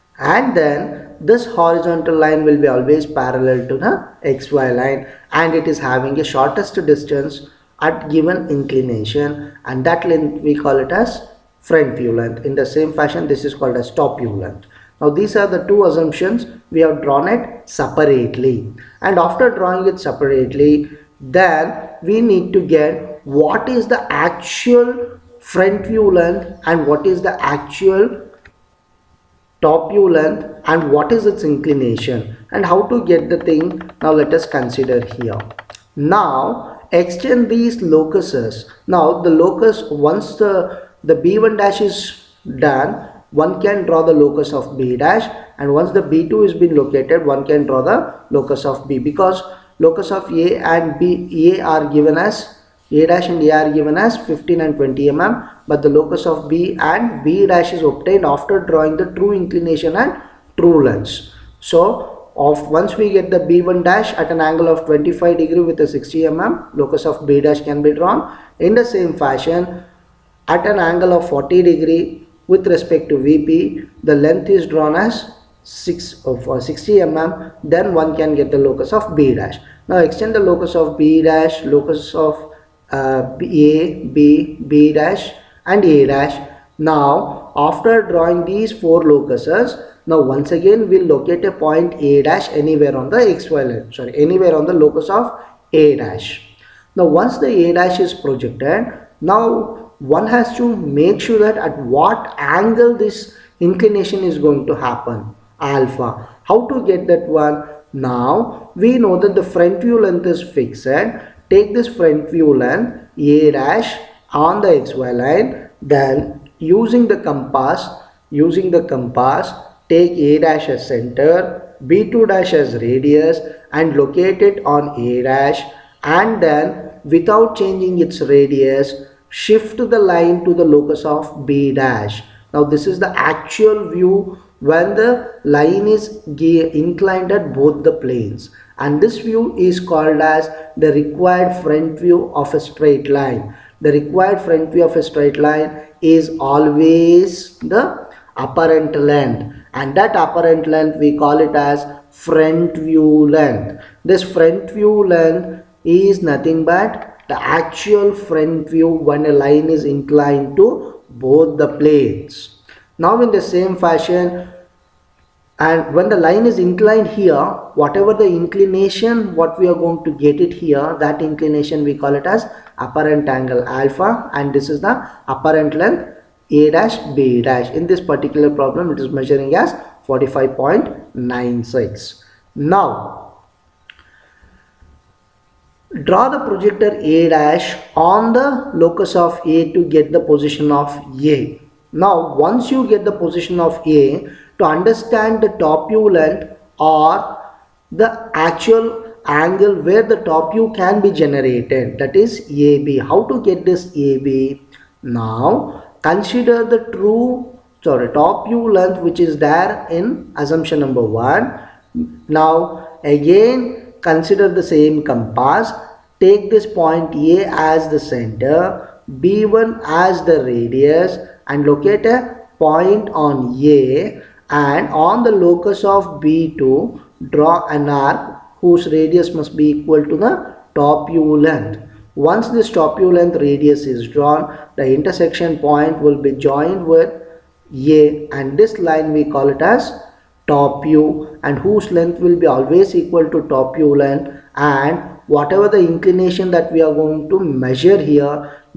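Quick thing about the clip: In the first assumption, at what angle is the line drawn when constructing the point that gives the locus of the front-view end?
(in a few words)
25 degrees.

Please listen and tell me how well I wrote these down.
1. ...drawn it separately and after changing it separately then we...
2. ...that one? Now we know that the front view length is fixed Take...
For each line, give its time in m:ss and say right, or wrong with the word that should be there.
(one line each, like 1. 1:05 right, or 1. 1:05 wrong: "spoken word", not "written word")
1. 0:17 wrong: "drawing", not "changing"
2. 1:47 right.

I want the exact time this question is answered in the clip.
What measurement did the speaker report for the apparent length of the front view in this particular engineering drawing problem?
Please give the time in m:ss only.
3:00.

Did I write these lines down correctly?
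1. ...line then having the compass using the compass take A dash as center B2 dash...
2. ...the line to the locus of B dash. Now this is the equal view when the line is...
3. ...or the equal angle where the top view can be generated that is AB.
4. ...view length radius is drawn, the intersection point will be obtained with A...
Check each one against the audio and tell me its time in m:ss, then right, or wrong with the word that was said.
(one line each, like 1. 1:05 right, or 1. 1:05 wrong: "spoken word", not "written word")
1. 1:55 wrong: "using", not "having"
2. 2:09 wrong: "actual", not "equal"
3. 3:16 wrong: "actual", not "equal"
4. 3:52 wrong: "joined", not "obtained".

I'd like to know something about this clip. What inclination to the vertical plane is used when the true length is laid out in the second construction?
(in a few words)
40 degrees.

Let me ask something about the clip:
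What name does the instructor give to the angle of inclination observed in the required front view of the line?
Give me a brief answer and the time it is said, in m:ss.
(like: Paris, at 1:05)
apparent angle alpha, at 2:52.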